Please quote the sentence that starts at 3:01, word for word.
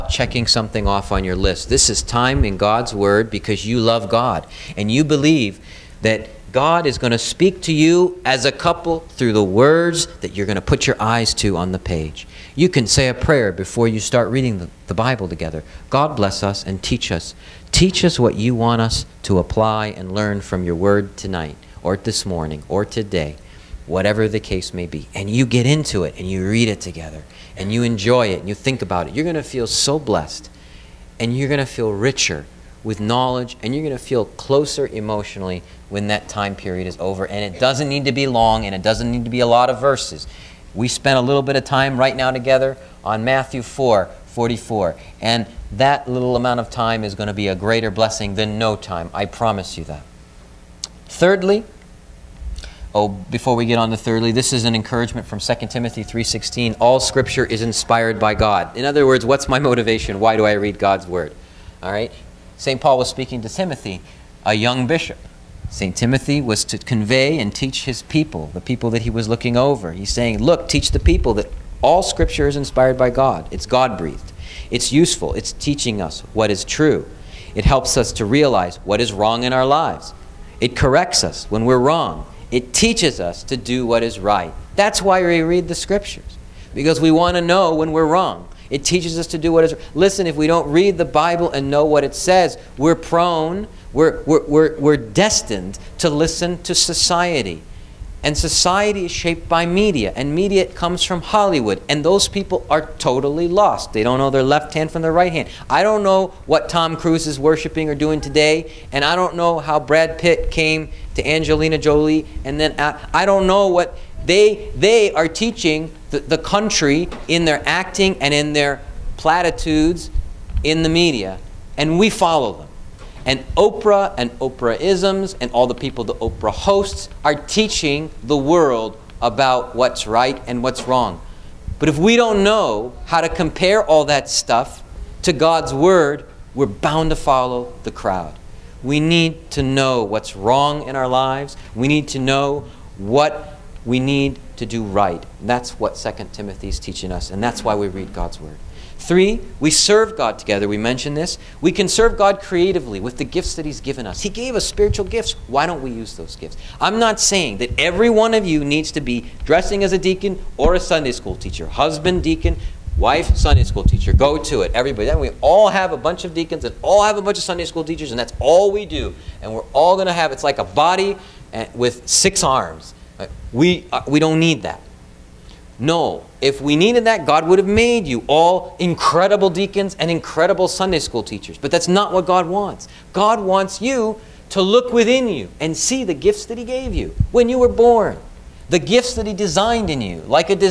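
But that's not what God wants.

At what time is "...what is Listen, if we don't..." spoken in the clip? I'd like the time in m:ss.
1:29.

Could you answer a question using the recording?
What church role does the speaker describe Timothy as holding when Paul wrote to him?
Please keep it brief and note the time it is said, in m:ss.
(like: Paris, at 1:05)
Bishop, at 1:04.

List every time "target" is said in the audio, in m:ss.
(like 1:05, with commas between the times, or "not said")
not said.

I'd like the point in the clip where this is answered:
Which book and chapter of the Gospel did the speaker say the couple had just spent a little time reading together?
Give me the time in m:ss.
0:43.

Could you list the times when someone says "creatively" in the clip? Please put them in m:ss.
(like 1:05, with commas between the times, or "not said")
2:32.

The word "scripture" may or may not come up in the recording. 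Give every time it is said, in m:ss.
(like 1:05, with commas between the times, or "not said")
0:56, 1:12, 1:25.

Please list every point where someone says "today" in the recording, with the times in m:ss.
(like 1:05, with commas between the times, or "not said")
0:22, 1:48.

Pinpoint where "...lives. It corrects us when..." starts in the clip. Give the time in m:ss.
1:19.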